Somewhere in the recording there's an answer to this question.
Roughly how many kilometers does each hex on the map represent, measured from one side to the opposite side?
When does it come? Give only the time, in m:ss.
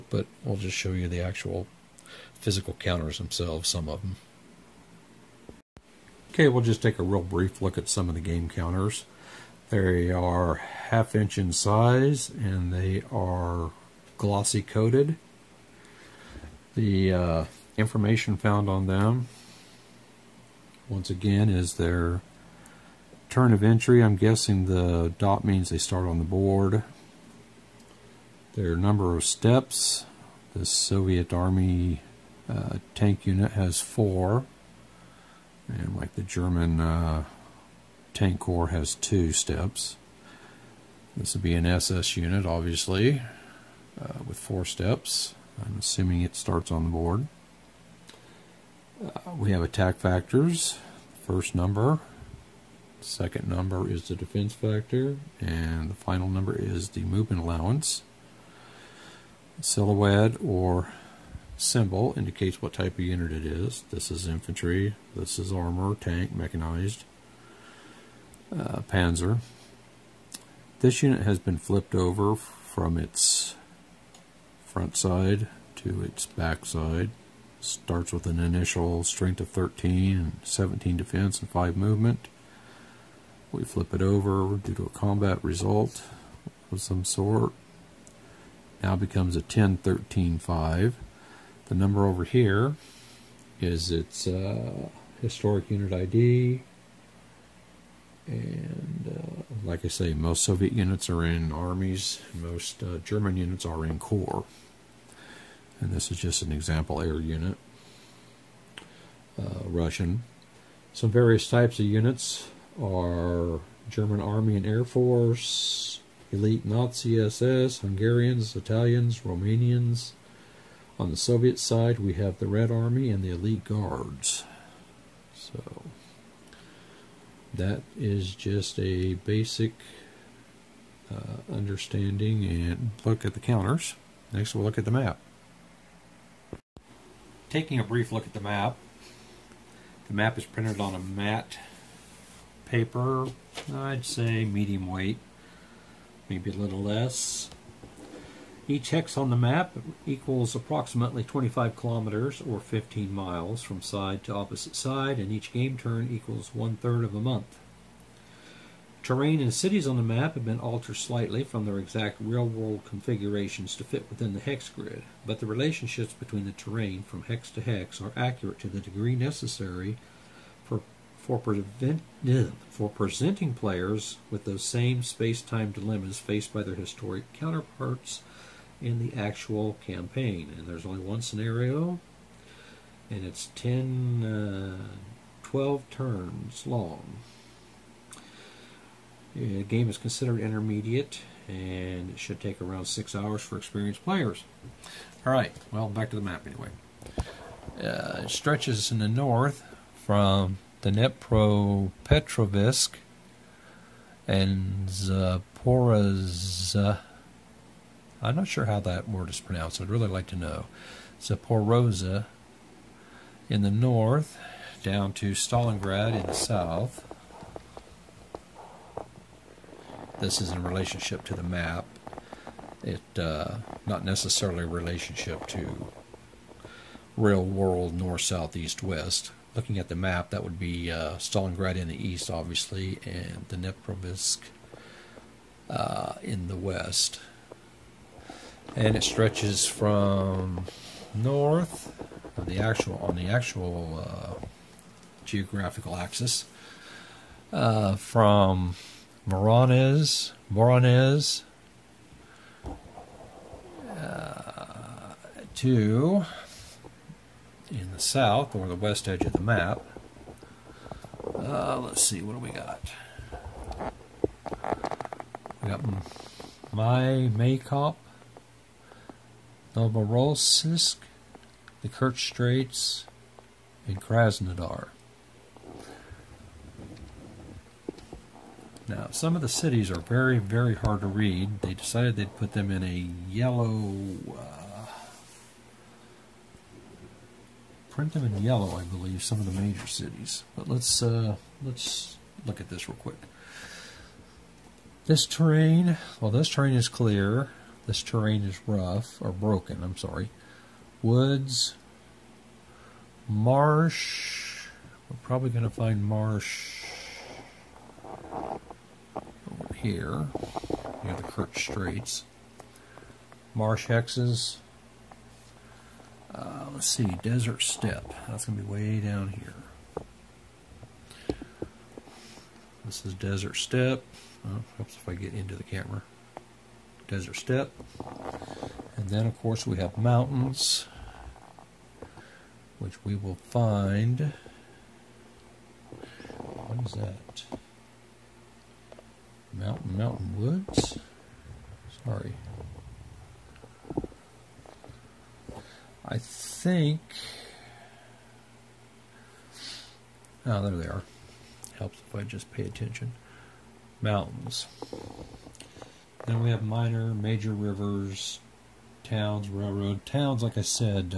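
2:31.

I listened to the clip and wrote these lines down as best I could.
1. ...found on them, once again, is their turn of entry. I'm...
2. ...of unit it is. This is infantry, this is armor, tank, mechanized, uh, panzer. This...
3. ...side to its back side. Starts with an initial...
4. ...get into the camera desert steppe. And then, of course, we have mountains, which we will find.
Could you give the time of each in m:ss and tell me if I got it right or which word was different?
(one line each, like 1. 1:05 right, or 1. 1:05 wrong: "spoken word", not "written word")
1. 0:18 right
2. 1:02 right
3. 1:14 right
4. 5:25 right.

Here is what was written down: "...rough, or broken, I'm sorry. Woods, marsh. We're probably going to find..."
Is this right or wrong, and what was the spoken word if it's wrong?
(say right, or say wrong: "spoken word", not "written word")
right.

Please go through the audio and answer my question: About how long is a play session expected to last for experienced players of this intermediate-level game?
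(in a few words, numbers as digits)
6 hours.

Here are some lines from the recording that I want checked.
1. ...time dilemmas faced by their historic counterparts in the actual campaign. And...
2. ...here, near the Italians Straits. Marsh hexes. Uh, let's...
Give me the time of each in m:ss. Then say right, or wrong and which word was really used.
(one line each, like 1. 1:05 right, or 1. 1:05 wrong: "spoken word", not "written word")
1. 2:55 right
2. 5:09 wrong: "Kerch", not "Italians".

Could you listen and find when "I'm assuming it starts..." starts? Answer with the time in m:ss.
0:45.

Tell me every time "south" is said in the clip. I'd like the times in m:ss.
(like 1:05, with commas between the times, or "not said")
3:36, 3:48, 4:17.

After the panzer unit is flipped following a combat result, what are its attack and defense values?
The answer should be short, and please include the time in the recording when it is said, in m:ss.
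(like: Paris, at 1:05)
10 13, at 1:29.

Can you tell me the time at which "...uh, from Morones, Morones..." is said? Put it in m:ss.
4:07.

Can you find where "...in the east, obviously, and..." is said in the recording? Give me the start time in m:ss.
3:51.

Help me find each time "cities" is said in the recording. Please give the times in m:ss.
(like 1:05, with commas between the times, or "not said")
2:39, 4:39, 4:49.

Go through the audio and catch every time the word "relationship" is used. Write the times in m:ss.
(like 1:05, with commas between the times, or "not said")
2:45, 3:40, 3:44.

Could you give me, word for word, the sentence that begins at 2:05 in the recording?
So that is just a basic uh, understanding and look at the counters.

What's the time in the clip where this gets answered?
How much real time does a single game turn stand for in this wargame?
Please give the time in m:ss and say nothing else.
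2:36.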